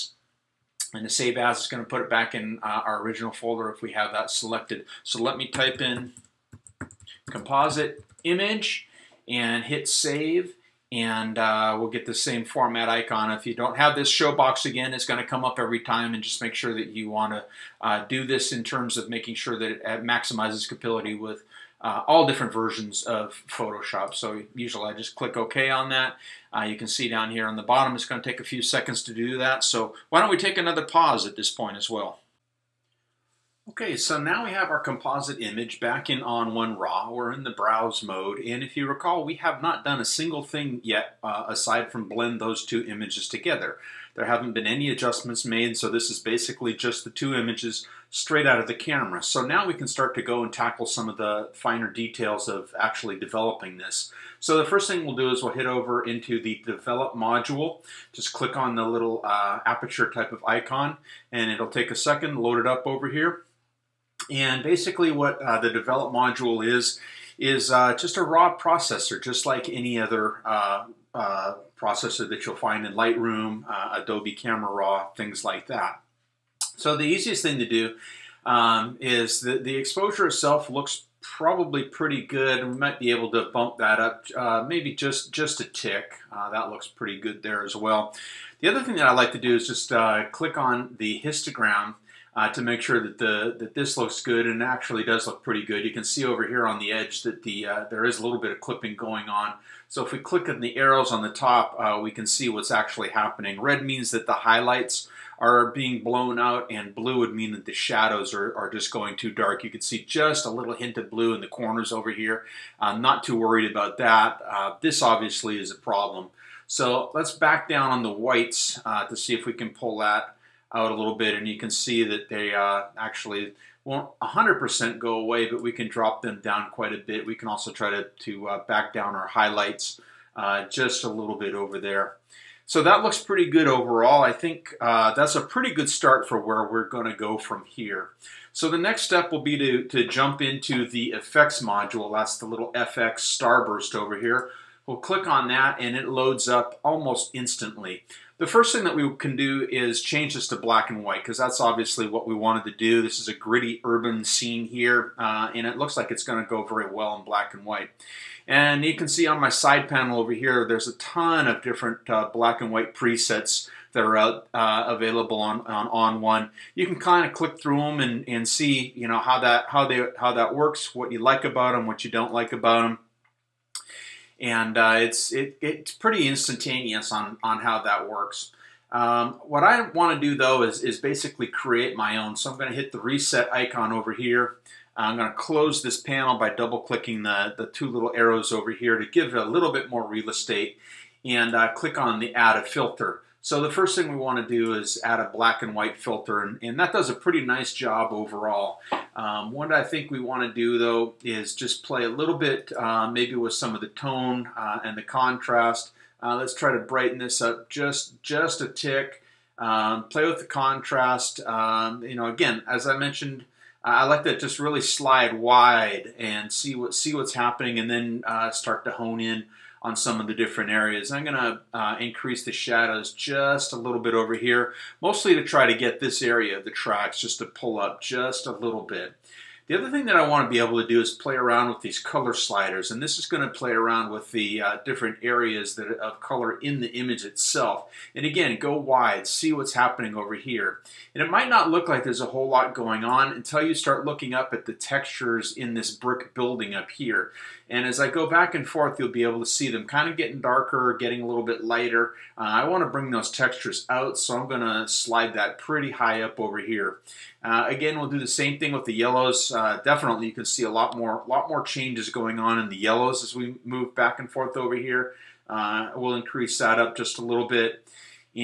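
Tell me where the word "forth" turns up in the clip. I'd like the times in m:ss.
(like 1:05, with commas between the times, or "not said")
4:08, 4:24.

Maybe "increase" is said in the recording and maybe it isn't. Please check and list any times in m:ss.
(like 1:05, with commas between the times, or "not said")
3:41, 4:26.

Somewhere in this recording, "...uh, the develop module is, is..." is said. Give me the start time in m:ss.
1:05.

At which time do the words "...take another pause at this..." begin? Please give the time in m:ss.
0:30.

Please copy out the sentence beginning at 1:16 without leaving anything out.
So the easiest thing to do um, is the, the exposure itself looks probably pretty good.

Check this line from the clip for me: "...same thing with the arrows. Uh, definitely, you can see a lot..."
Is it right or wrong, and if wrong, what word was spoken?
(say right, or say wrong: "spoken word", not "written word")
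wrong: "yellows", not "arrows".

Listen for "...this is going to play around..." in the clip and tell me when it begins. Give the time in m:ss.
3:52.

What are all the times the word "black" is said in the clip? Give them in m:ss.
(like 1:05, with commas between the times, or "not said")
2:30, 2:37, 2:42, 3:15.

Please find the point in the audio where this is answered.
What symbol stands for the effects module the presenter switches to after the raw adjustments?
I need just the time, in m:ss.
2:22.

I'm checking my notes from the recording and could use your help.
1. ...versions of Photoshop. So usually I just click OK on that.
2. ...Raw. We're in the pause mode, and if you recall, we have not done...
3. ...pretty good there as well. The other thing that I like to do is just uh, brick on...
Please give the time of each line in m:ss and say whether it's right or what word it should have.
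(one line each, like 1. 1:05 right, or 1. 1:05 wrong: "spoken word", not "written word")
1. 0:22 right
2. 0:36 wrong: "browse", not "pause"
3. 1:26 wrong: "click", not "brick".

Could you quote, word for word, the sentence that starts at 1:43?
Red means that the highlights are being blown out and blue would mean that the shadows are, are just going too dark.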